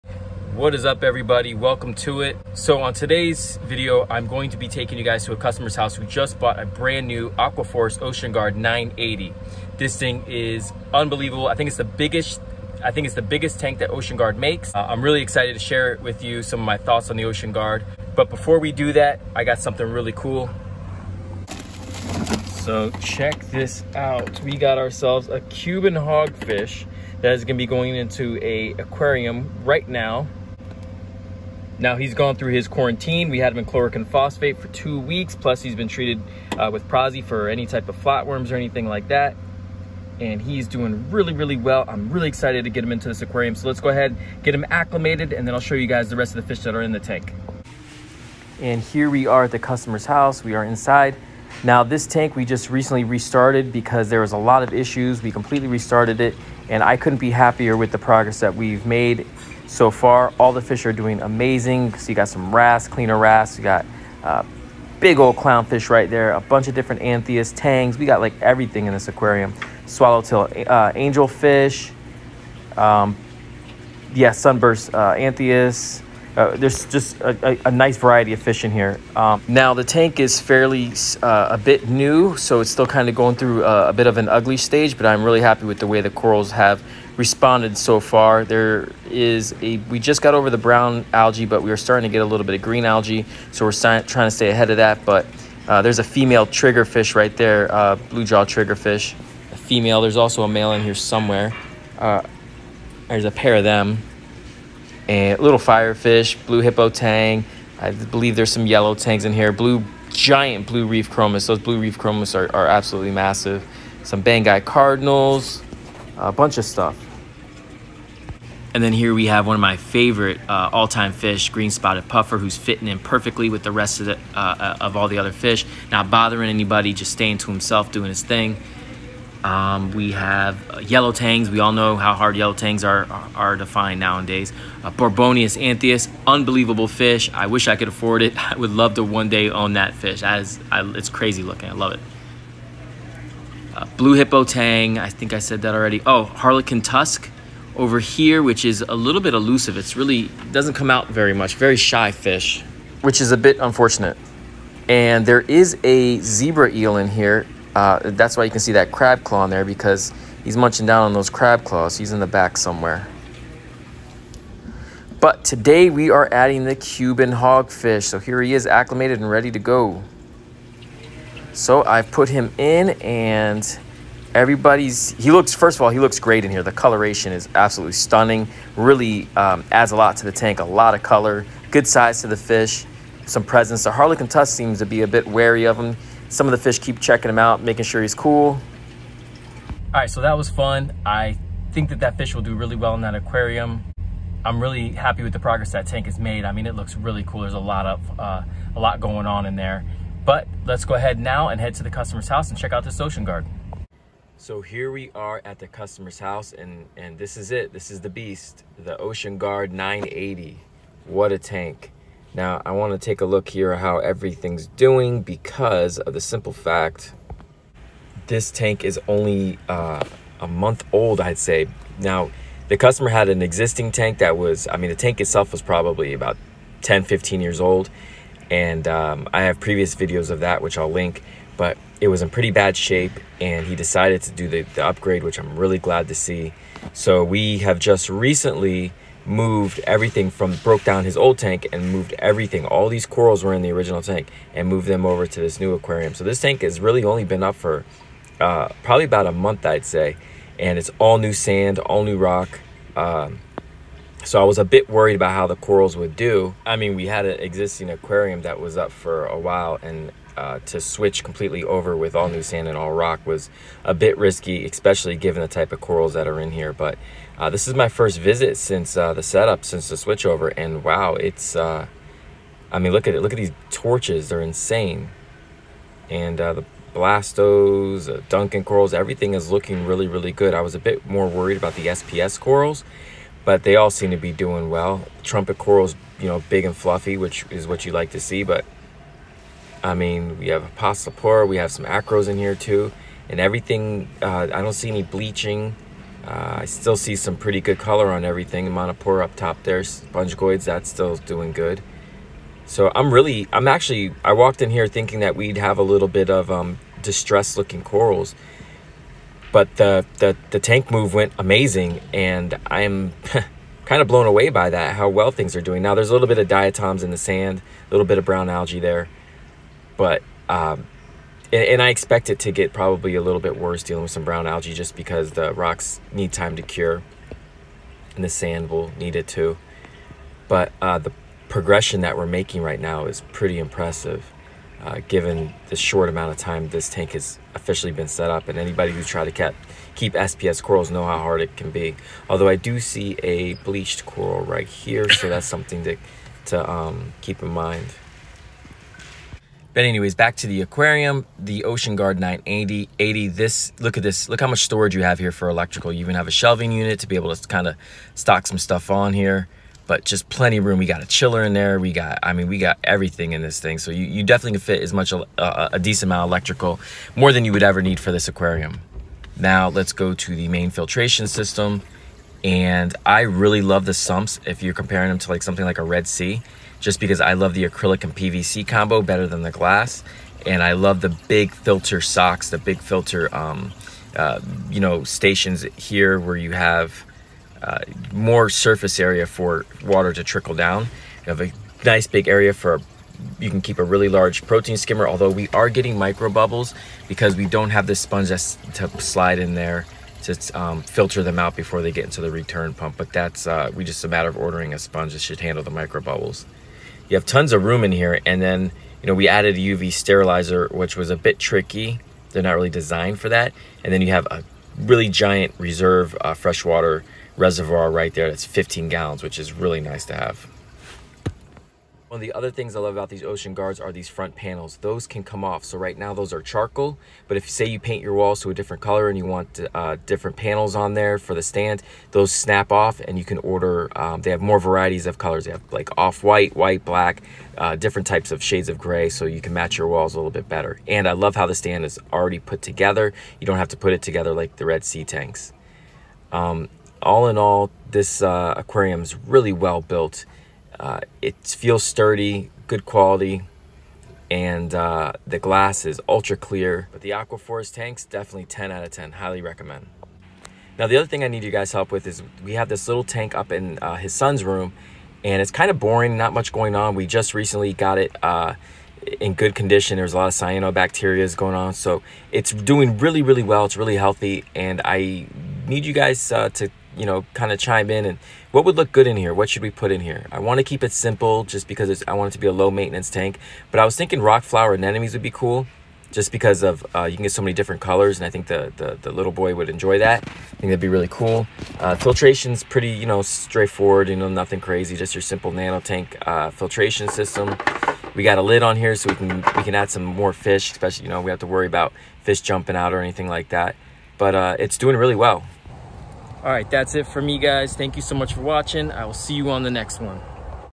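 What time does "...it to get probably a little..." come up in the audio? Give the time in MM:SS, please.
05:22.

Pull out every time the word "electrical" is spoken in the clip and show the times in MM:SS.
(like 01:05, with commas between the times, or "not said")
05:55, 06:06.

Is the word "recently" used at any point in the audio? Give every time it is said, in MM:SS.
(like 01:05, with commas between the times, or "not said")
00:52, 03:58, 07:47.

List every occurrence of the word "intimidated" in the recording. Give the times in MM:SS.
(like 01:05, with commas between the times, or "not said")
not said.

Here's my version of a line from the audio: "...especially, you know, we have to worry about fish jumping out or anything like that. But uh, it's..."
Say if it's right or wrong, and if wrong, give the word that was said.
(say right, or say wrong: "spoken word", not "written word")
right.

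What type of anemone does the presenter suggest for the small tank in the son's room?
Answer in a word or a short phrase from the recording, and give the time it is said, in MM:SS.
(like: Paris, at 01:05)
Rock flower anemones, at 08:04.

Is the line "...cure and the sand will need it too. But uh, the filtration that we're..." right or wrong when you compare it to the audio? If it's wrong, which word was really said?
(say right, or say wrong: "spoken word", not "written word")
wrong: "progression", not "filtration".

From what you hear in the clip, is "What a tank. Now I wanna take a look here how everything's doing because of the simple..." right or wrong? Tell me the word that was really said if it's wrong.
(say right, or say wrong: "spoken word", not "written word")
right.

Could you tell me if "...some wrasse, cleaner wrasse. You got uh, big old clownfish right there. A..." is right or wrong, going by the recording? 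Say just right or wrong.
right.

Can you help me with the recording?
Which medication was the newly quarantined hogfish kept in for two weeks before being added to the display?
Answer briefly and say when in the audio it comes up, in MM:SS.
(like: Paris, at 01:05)
Chloroquine phosphate, at 00:33.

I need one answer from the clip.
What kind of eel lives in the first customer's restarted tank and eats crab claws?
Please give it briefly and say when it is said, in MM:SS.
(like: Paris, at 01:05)
Zebra eel, at 02:36.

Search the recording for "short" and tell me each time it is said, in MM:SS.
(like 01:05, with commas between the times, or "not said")
05:35.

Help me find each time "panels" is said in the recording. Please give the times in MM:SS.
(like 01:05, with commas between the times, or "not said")
07:04, 07:10.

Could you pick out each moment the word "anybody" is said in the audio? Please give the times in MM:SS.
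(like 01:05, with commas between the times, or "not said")
02:06, 05:38.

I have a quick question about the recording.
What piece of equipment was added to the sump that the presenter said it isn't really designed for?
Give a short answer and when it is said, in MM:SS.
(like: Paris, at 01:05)
UV sterilizer, at 06:49.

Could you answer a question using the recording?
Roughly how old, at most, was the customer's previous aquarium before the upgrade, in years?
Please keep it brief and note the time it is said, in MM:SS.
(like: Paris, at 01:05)
15, at 03:47.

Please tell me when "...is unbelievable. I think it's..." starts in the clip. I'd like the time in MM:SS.
00:10.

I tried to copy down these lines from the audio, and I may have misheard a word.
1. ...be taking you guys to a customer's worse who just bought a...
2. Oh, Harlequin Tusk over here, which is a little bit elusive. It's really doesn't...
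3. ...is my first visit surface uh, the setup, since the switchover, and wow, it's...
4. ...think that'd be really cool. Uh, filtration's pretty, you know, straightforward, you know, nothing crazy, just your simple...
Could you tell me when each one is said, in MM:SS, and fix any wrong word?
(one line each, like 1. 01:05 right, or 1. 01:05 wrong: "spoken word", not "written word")
1. 00:04 wrong: "house", not "worse"
2. 02:26 right
3. 04:27 wrong: "since", not "surface"
4. 08:10 right.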